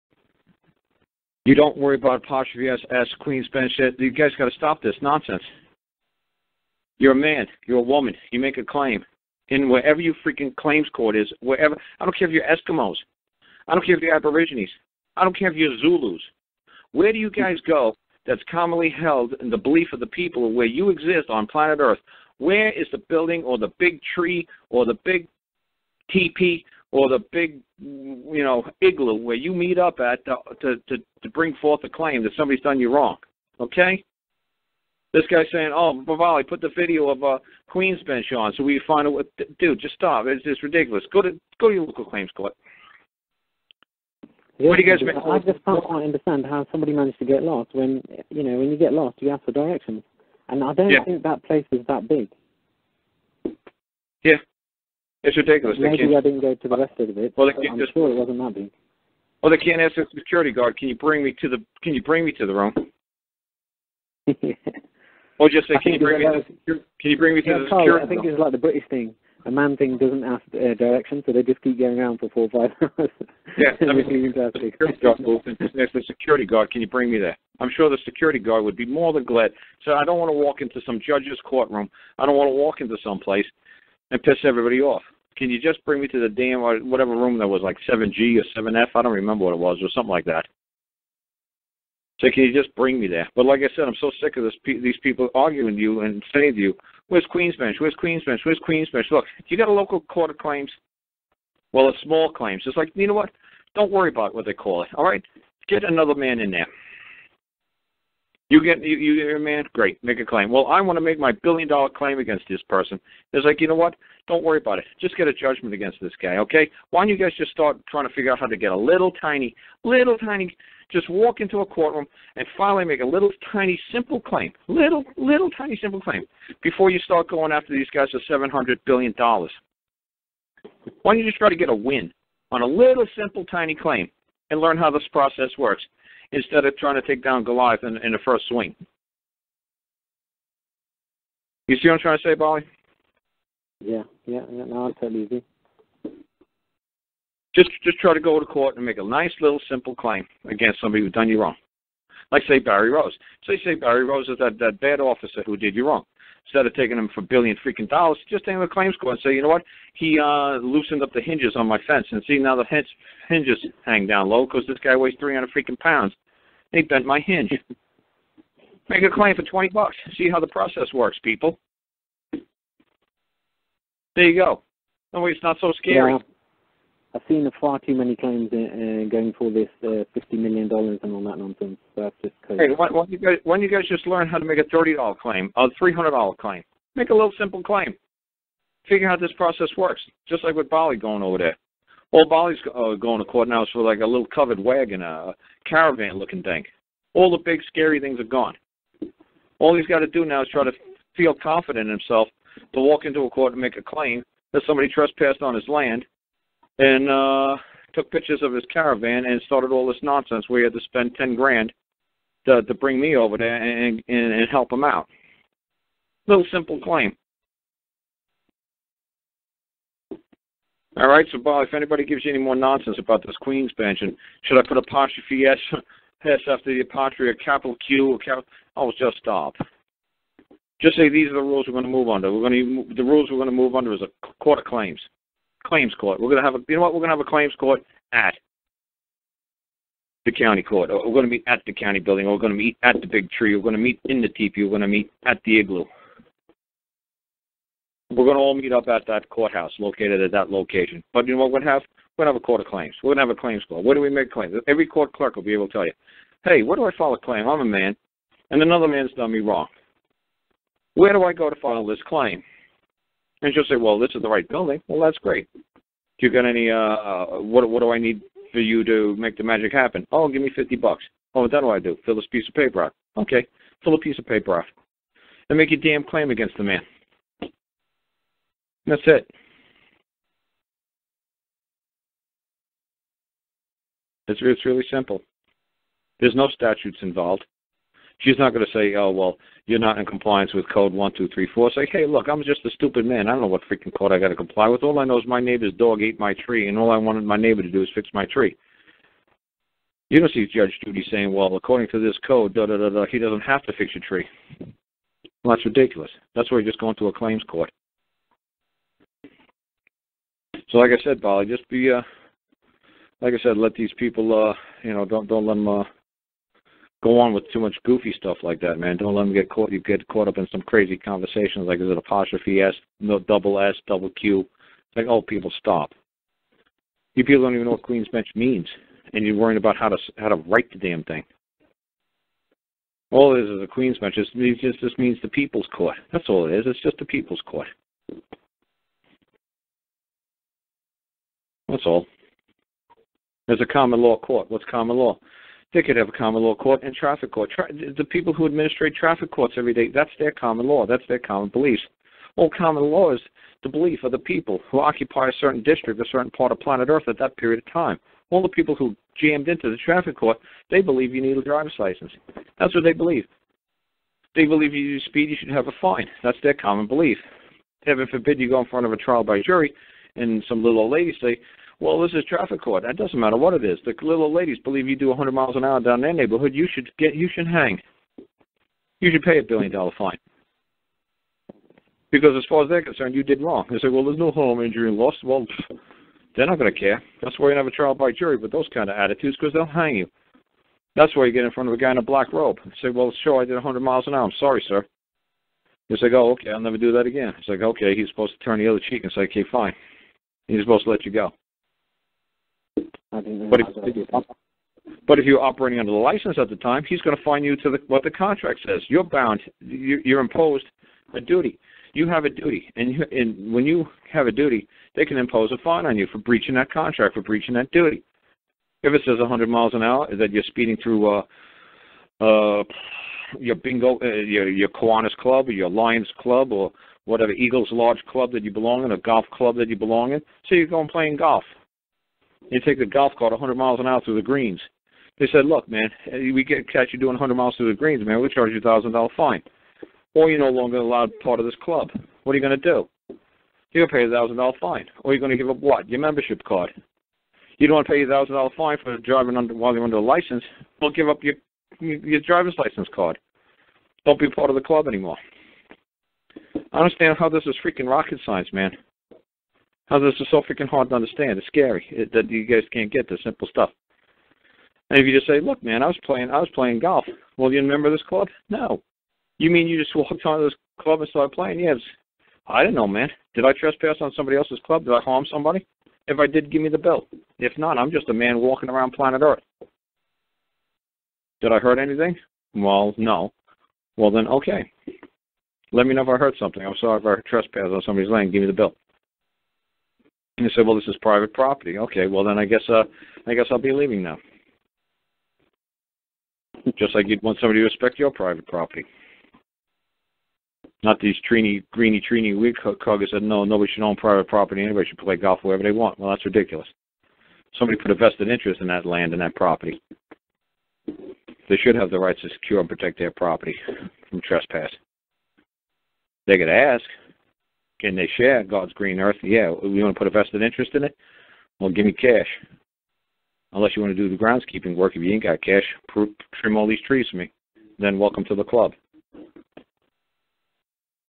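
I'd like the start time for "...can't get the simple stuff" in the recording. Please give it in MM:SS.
07:42.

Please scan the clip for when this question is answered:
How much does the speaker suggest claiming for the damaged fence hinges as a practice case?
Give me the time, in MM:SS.
02:49.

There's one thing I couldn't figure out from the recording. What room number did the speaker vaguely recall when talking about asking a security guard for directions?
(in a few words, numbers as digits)
7G.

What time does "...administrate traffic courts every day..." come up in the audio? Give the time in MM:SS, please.
05:48.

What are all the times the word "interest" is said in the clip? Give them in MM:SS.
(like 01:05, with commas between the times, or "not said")
08:28, 08:40.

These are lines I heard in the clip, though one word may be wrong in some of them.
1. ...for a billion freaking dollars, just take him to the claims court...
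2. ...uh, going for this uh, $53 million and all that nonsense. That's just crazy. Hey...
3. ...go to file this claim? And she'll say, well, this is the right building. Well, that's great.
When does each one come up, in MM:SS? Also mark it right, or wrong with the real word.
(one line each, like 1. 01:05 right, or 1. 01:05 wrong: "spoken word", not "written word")
1. 02:37 right
2. 02:58 wrong: "50", not "53"
3. 04:21 right.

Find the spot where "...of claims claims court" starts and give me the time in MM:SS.
03:54.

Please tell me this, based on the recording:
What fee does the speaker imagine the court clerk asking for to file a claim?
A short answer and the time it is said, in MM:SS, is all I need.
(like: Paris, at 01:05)
50 bucks, at 04:30.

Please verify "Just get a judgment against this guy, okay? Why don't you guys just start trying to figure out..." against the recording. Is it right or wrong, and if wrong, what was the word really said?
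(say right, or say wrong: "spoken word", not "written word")
right.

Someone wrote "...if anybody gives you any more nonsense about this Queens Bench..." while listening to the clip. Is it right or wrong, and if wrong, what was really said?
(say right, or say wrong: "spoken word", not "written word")
right.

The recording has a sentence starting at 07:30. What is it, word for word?
Well, give up your your driver's license card.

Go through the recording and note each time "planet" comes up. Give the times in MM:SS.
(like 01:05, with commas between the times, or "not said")
00:21, 05:56, 07:58.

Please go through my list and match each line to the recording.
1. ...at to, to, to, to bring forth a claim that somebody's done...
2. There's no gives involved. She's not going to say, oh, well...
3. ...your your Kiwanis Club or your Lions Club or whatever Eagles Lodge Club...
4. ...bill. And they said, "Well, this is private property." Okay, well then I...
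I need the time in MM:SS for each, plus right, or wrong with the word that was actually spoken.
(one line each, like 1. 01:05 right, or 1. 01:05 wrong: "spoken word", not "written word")
1. 00:29 right
2. 04:46 wrong: "statutes", not "gives"
3. 07:04 right
4. 08:08 right.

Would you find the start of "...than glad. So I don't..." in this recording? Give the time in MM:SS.
01:19.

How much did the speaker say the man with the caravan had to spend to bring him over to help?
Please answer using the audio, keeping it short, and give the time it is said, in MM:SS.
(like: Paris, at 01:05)
ten grand, at 03:31.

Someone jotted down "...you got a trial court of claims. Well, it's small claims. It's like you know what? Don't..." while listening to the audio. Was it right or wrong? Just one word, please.
wrong.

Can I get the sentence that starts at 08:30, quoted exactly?
They should have the rights to secure and protect their property from trespass.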